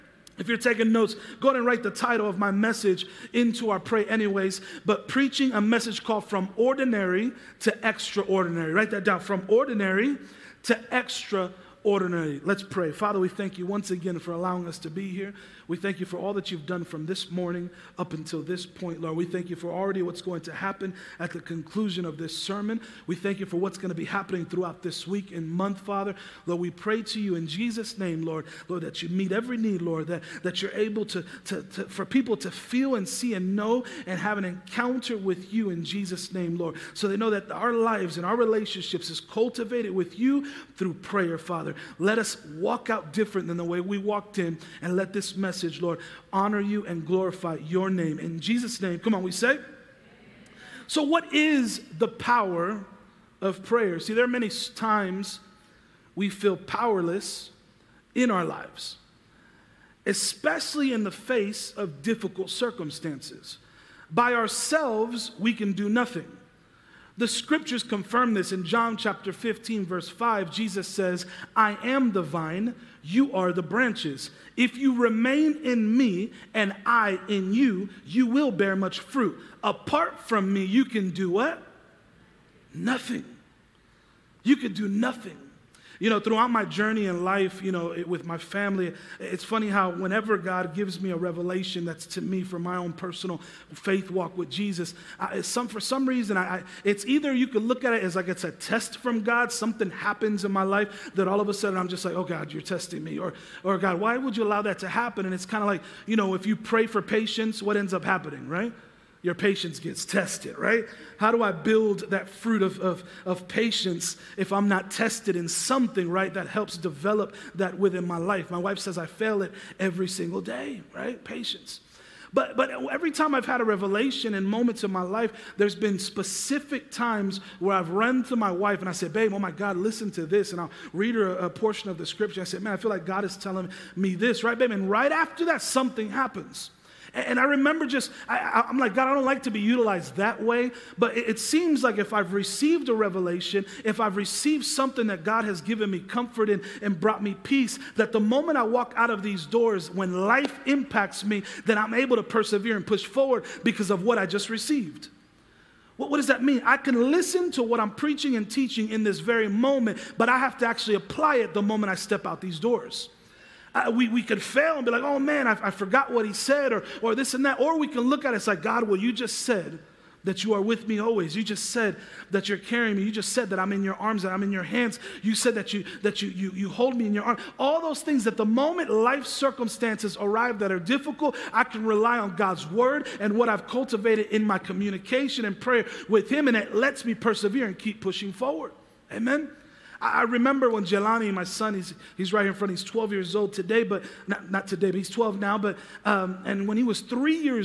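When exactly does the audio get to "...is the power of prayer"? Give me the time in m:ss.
0:51.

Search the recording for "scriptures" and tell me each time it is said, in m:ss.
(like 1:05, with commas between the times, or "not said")
1:07, 2:12.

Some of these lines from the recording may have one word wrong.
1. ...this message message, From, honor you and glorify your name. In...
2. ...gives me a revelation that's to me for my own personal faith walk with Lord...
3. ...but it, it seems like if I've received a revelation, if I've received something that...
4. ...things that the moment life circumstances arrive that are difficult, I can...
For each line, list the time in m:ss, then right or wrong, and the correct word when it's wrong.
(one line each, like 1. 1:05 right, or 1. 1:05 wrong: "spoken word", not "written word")
1. 0:45 wrong: "Lord", not "From"
2. 1:30 wrong: "Jesus", not "Lord"
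3. 2:20 right
4. 2:57 right.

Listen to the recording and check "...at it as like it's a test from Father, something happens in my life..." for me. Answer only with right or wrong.
wrong.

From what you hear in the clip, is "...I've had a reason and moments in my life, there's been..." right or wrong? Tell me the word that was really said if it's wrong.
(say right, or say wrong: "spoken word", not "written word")
wrong: "revelation", not "reason".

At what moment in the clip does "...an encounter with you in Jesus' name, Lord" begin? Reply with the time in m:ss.
0:34.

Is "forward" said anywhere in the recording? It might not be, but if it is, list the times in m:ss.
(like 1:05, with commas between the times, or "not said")
2:33, 3:08.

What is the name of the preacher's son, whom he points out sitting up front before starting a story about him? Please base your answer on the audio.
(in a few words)
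Jelani.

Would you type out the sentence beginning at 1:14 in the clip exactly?
If you remain in me and I in you, you will bear much fruit.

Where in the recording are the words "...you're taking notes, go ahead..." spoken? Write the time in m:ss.
0:00.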